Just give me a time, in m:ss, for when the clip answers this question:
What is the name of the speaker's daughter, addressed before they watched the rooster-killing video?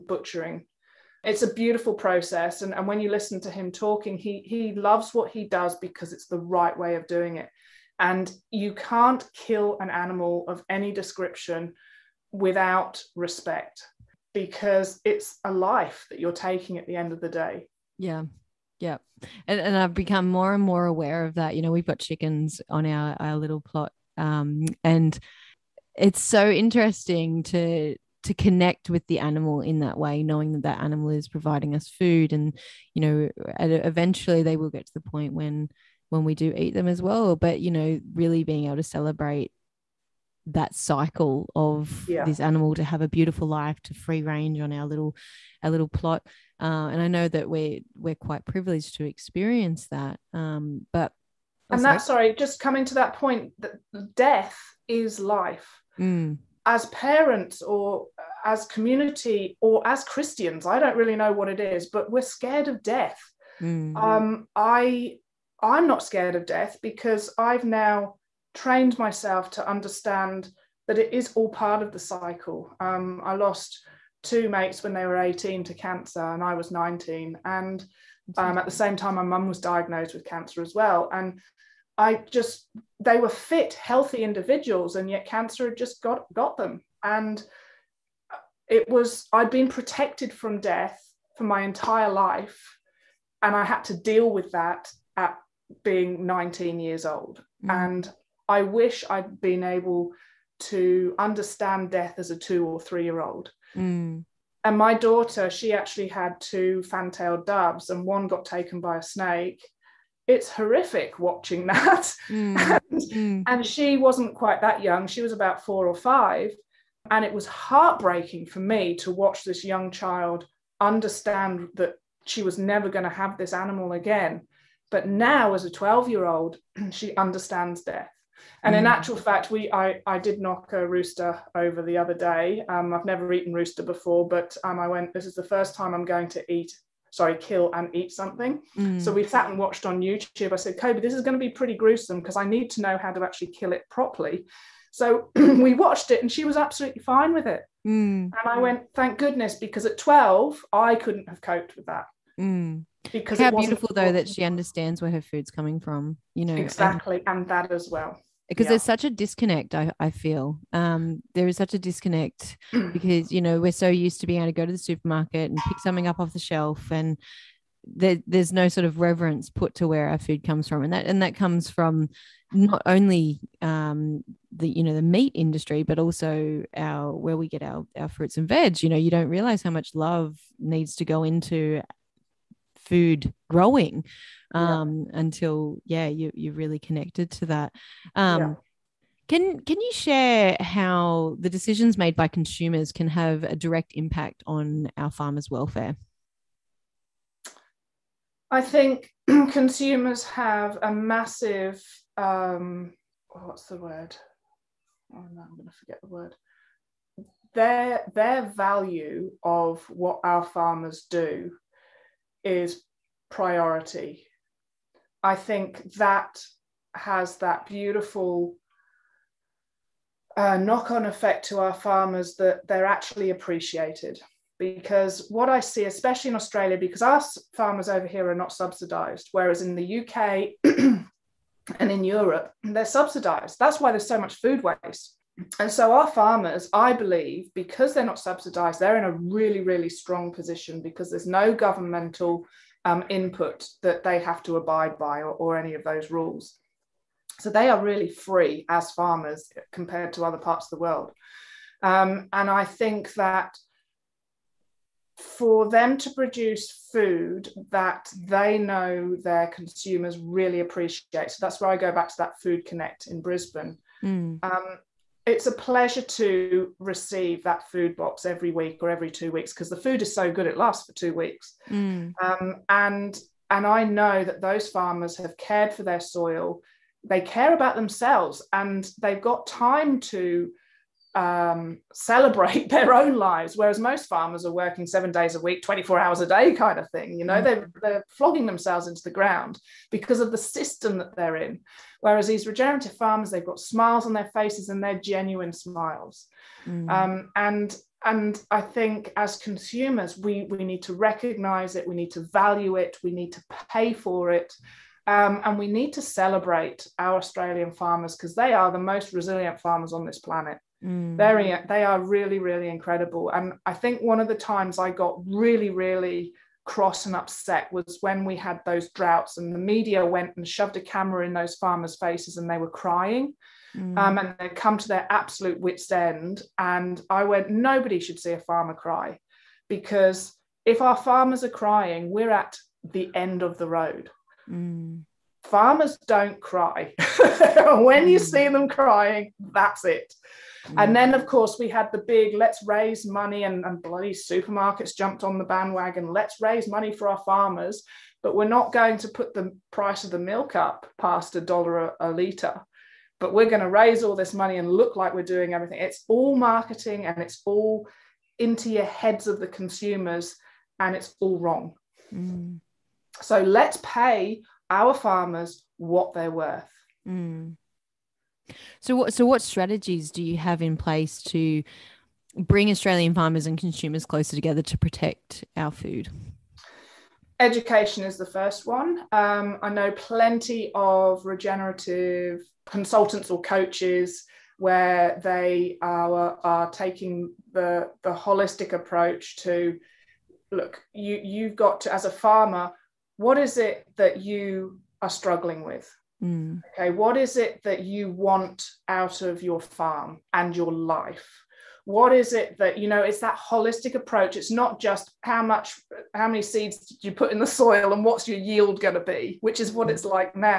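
2:20.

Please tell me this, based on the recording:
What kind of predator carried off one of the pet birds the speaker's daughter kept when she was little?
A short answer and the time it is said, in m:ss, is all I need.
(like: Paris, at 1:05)
snake, at 1:49.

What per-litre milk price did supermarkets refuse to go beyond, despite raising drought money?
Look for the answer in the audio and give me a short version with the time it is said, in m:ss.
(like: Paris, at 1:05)
a dollar, at 5:51.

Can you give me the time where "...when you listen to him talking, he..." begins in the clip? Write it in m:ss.
0:02.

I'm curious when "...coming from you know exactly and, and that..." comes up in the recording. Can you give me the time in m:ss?
2:35.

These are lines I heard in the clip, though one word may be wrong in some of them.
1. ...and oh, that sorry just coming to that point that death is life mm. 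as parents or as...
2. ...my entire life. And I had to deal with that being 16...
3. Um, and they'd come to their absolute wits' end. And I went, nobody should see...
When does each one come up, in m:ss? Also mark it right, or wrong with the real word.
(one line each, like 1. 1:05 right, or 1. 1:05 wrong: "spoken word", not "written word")
1. 0:51 right
2. 1:31 wrong: "19", not "16"
3. 5:23 right.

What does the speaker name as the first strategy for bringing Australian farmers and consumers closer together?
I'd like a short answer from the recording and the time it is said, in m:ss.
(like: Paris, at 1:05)
Education, at 6:17.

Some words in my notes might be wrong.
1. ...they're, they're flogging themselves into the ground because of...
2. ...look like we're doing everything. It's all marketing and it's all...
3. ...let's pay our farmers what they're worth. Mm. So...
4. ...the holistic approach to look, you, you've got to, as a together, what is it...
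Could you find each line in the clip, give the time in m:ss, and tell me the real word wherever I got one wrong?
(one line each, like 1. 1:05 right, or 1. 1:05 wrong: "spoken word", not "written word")
1. 4:47 right
2. 5:54 right
3. 6:03 right
4. 6:28 wrong: "farmer", not "together".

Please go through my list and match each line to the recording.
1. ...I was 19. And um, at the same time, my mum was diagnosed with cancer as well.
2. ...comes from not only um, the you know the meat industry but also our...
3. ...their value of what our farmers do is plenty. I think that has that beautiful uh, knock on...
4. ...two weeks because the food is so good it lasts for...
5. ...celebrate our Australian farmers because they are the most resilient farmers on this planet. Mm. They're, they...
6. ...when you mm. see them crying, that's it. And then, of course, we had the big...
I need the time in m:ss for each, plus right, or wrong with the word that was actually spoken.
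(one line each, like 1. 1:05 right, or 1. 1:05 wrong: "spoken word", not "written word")
1. 1:16 right
2. 2:51 right
3. 3:28 wrong: "priority", not "plenty"
4. 4:29 right
5. 5:06 right
6. 5:37 right.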